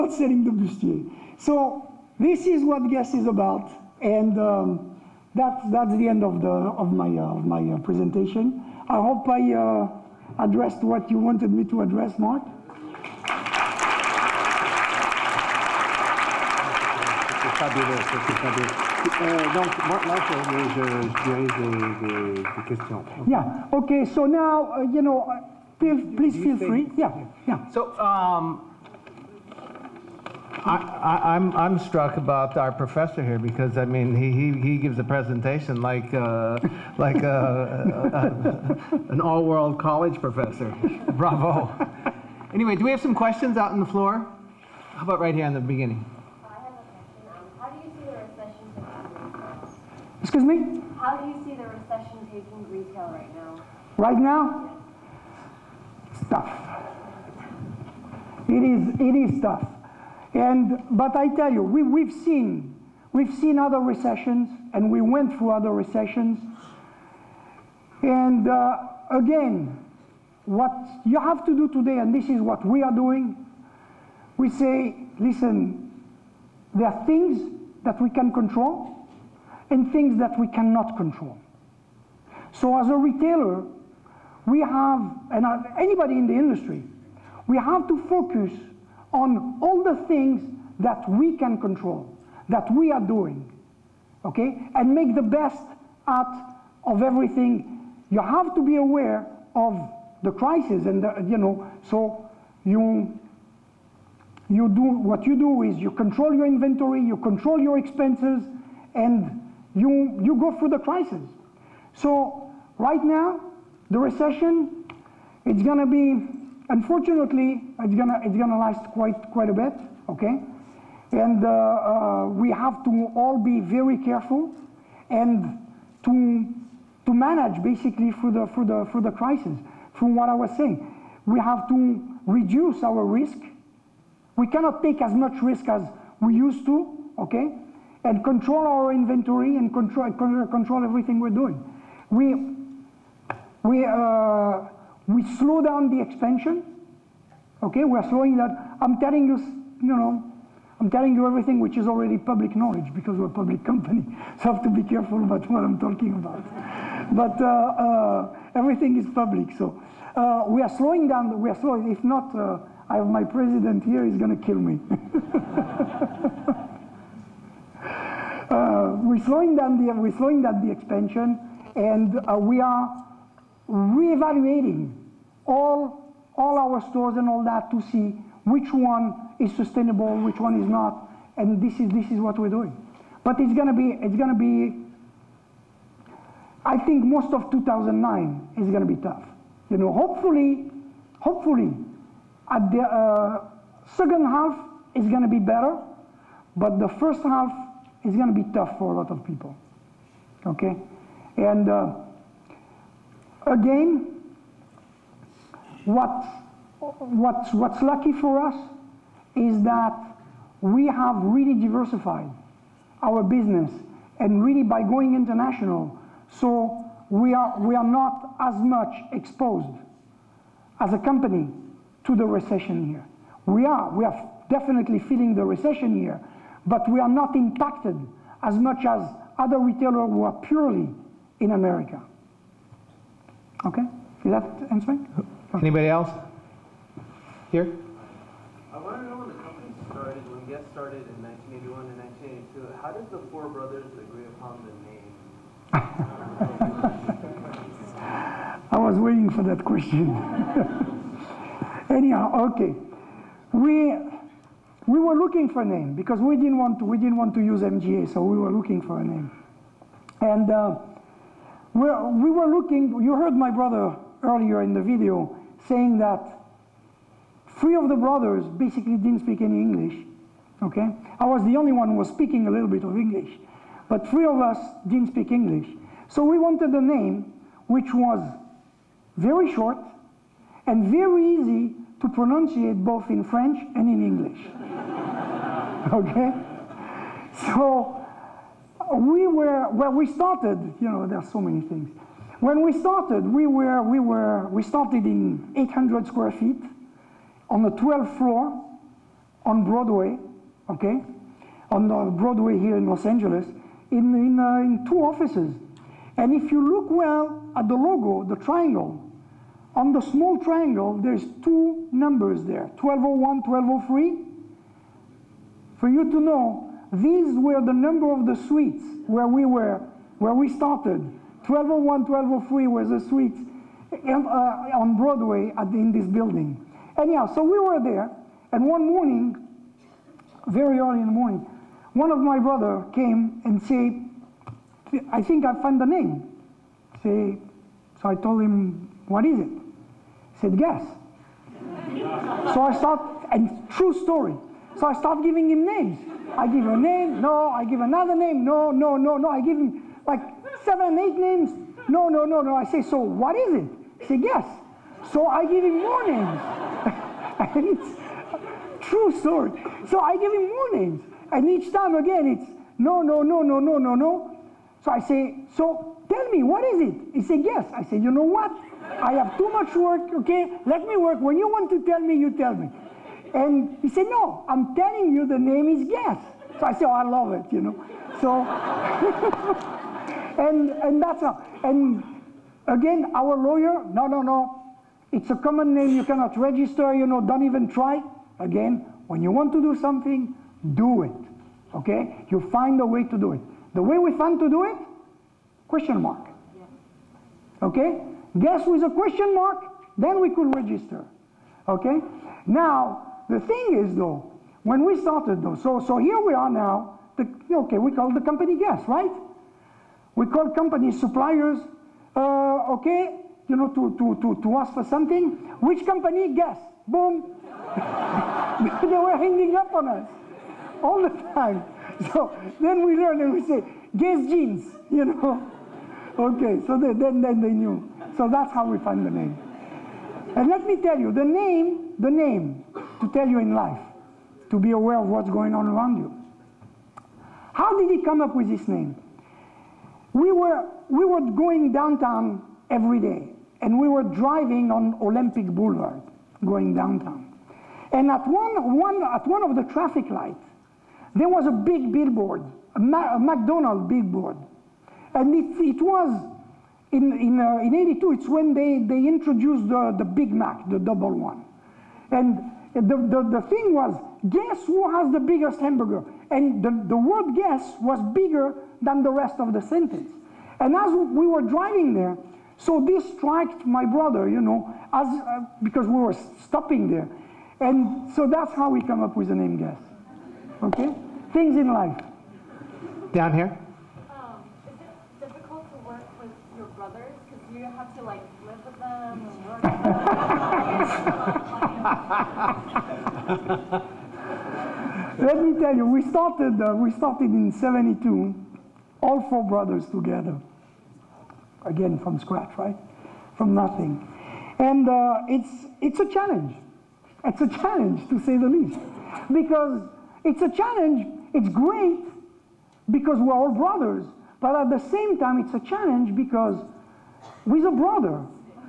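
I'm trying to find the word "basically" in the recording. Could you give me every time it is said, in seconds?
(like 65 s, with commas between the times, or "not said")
127 s, 268 s.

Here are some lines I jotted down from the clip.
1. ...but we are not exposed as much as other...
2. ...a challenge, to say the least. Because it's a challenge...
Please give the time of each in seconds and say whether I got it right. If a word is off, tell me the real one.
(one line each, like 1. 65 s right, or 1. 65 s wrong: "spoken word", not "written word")
1. 226 s wrong: "impacted", not "exposed"
2. 507 s right.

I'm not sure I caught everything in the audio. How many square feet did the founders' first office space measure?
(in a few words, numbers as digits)
800.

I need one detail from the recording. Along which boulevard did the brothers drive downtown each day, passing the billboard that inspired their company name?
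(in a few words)
Olympic Boulevard.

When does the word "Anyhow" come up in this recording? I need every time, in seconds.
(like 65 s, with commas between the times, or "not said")
251 s, 326 s.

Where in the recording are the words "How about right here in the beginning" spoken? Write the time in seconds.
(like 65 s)
44 s.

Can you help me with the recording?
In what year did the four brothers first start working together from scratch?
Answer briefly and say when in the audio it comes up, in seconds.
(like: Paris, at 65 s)
1972, at 497 s.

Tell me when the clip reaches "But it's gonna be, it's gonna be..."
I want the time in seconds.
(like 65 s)
183 s.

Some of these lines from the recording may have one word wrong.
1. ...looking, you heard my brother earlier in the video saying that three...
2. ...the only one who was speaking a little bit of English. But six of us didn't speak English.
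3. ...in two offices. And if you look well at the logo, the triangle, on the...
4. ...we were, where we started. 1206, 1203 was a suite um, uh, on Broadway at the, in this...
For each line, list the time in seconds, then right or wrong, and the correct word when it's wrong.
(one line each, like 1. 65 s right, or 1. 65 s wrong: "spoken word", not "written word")
1. 262 s right
2. 271 s wrong: "three", not "six"
3. 304 s right
4. 319 s wrong: "1201", not "1206".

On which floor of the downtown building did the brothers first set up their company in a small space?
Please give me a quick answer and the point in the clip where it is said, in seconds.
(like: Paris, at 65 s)
12th floor, at 297 s.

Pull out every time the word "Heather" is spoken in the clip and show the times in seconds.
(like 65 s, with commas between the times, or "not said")
not said.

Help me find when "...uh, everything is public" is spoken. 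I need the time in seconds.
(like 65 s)
157 s.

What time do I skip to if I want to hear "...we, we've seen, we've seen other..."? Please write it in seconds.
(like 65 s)
61 s.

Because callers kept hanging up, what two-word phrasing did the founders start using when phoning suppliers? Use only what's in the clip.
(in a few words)
Guess jeans.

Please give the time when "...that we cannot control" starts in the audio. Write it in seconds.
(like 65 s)
80 s.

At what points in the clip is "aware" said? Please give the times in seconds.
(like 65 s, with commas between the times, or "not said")
98 s, 434 s.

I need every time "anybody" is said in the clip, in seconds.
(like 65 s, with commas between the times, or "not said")
85 s, 235 s.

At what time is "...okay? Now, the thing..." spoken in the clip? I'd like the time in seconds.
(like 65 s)
401 s.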